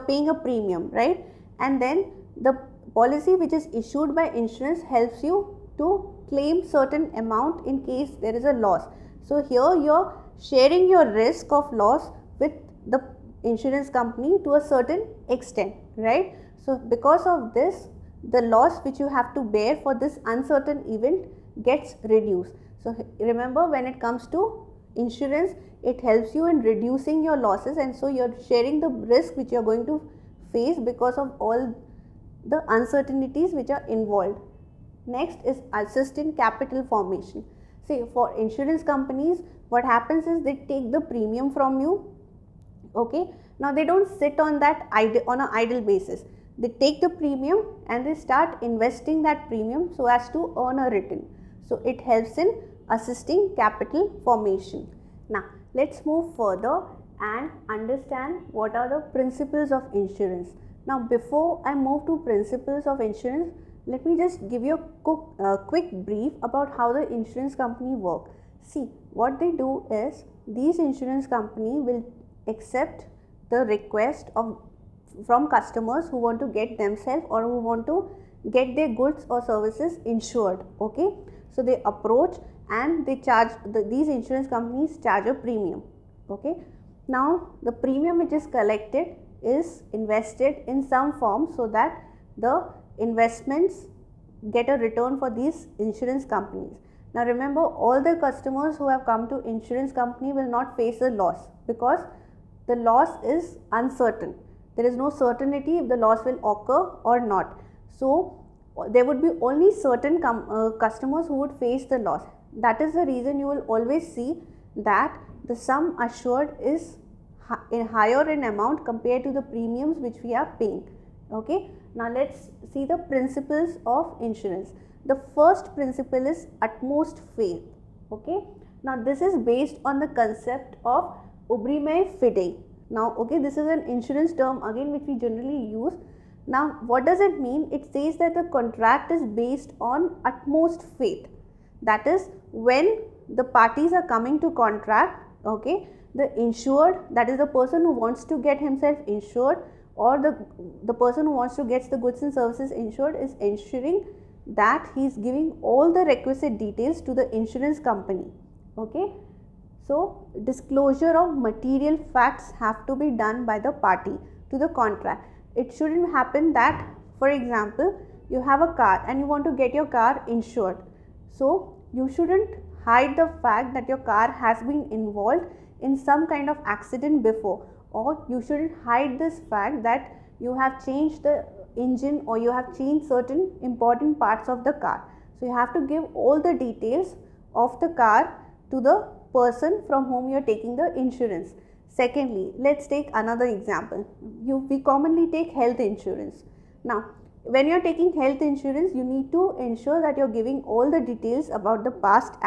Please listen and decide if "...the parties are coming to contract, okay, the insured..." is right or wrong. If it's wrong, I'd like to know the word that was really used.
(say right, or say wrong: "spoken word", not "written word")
right.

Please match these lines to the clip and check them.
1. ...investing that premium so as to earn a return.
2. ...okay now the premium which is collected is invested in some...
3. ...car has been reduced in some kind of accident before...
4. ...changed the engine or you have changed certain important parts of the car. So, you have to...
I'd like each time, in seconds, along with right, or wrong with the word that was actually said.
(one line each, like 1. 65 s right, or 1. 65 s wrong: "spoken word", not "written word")
1. 48 s right
2. 86 s right
3. 173 s wrong: "involved", not "reduced"
4. 180 s right.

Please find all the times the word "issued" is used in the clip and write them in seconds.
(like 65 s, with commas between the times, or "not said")
3 s.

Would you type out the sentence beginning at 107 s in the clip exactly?
So, there would be only certain uh, customers who would face the loss.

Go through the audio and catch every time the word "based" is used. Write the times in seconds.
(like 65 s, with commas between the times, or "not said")
129 s, 139 s.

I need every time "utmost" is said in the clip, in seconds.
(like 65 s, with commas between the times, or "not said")
126 s, 140 s.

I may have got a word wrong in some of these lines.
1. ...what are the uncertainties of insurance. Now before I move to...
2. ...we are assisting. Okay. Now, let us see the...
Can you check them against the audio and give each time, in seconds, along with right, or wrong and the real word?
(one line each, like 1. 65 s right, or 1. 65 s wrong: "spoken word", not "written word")
1. 58 s wrong: "principles", not "uncertainties"
2. 120 s wrong: "paying", not "assisting".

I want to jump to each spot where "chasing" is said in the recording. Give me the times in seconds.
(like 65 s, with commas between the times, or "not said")
not said.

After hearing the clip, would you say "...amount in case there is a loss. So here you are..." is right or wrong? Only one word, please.
right.